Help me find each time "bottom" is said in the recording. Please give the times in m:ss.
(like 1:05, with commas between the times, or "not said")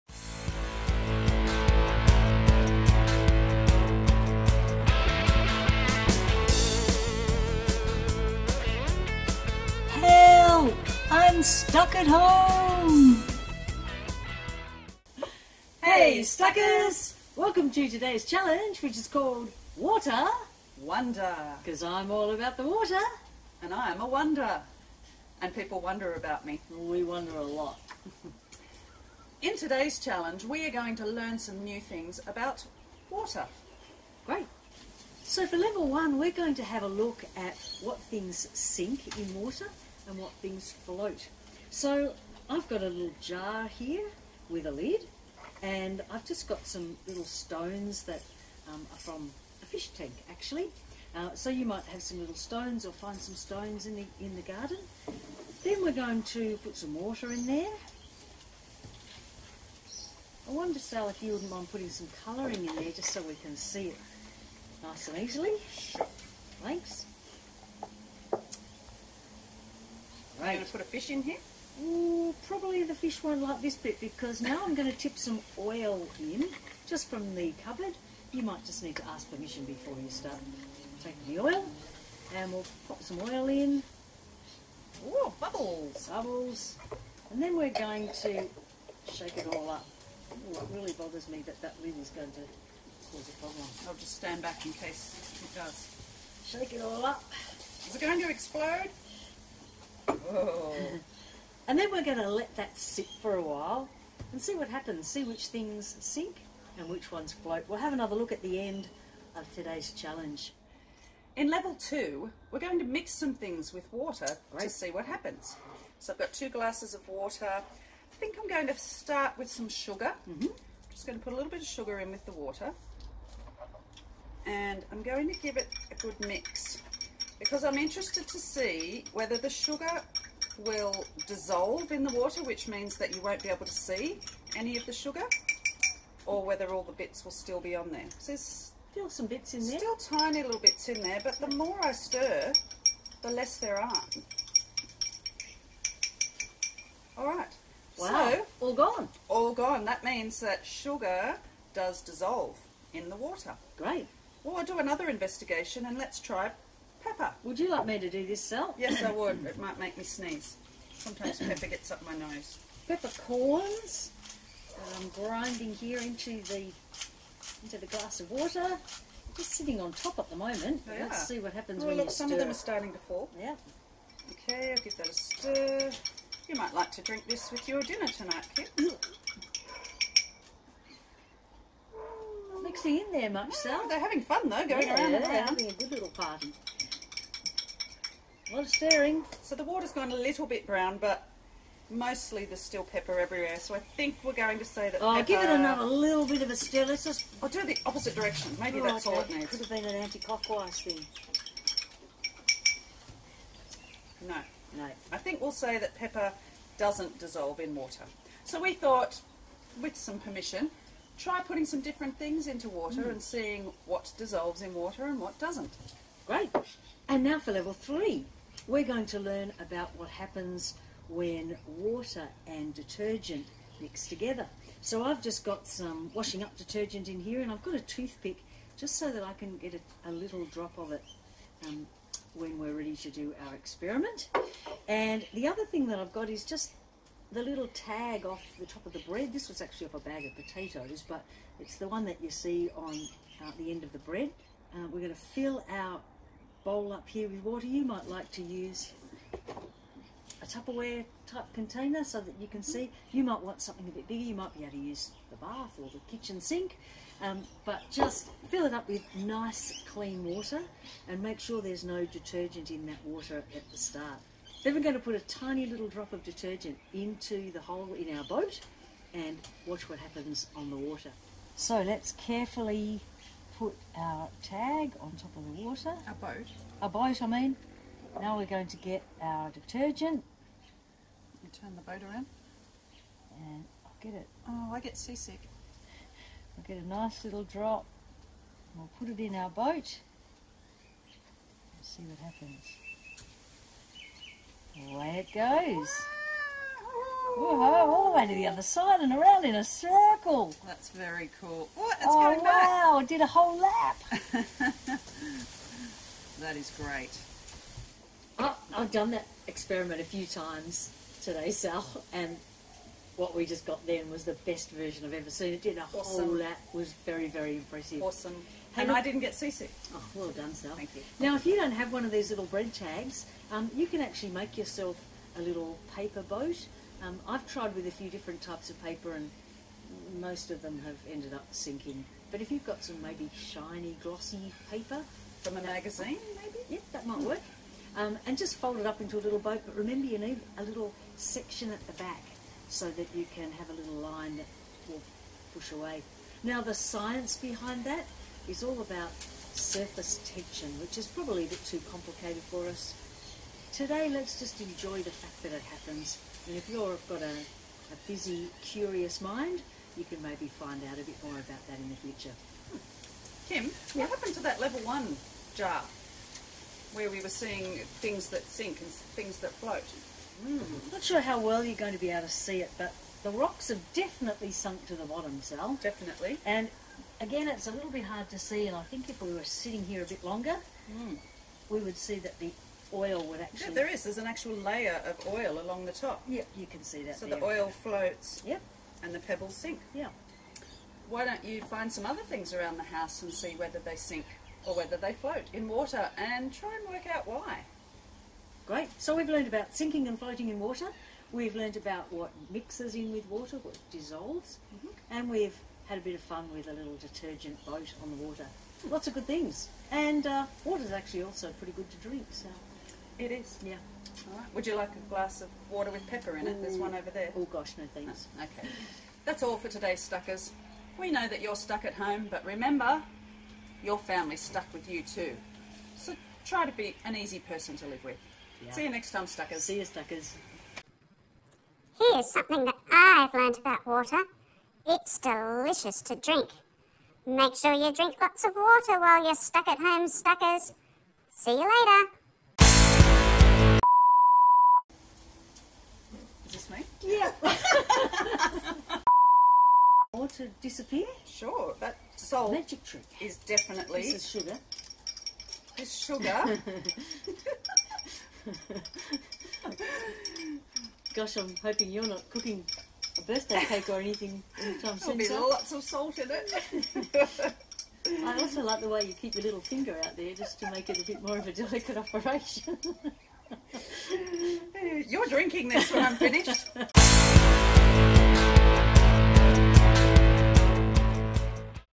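6:15.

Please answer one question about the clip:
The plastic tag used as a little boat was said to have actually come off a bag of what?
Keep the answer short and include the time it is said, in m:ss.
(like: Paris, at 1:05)
Potatoes, at 4:00.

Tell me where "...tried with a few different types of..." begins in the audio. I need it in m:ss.
5:27.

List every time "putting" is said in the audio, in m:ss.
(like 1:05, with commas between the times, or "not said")
1:01, 3:31.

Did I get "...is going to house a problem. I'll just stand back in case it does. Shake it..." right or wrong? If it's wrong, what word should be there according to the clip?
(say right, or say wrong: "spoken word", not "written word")
wrong: "cause", not "house".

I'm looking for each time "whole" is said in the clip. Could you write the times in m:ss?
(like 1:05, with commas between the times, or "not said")
5:03, 5:16.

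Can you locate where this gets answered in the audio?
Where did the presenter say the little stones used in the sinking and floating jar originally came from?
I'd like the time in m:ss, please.
0:48.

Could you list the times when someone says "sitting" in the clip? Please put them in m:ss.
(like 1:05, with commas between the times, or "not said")
2:49, 6:19.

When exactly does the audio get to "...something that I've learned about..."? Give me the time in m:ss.
7:12.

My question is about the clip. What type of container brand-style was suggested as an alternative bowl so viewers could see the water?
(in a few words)
Tupperware.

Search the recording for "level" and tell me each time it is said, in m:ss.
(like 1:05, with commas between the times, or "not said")
0:35, 1:51, 3:37, 6:04.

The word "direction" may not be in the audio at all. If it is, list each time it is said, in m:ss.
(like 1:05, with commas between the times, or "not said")
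3:18.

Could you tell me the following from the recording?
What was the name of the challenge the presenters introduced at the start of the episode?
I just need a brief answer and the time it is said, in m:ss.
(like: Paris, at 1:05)
Water Wonder, at 0:19.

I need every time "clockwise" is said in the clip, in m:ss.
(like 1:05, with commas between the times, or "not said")
3:19.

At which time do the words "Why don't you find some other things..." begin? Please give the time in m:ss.
6:31.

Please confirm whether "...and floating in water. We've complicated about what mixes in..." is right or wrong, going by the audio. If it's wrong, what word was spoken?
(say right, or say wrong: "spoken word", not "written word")
wrong: "learned", not "complicated".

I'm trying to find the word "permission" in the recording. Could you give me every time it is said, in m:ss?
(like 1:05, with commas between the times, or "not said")
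1:19, 3:30.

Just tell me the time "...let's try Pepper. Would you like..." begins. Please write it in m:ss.
2:35.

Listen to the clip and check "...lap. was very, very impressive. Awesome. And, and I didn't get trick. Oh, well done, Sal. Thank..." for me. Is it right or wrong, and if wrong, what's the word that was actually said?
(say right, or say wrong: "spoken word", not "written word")
wrong: "seasick", not "trick".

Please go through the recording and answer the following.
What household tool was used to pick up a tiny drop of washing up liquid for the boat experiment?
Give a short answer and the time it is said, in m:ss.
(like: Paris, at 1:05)
A toothpick, at 3:47.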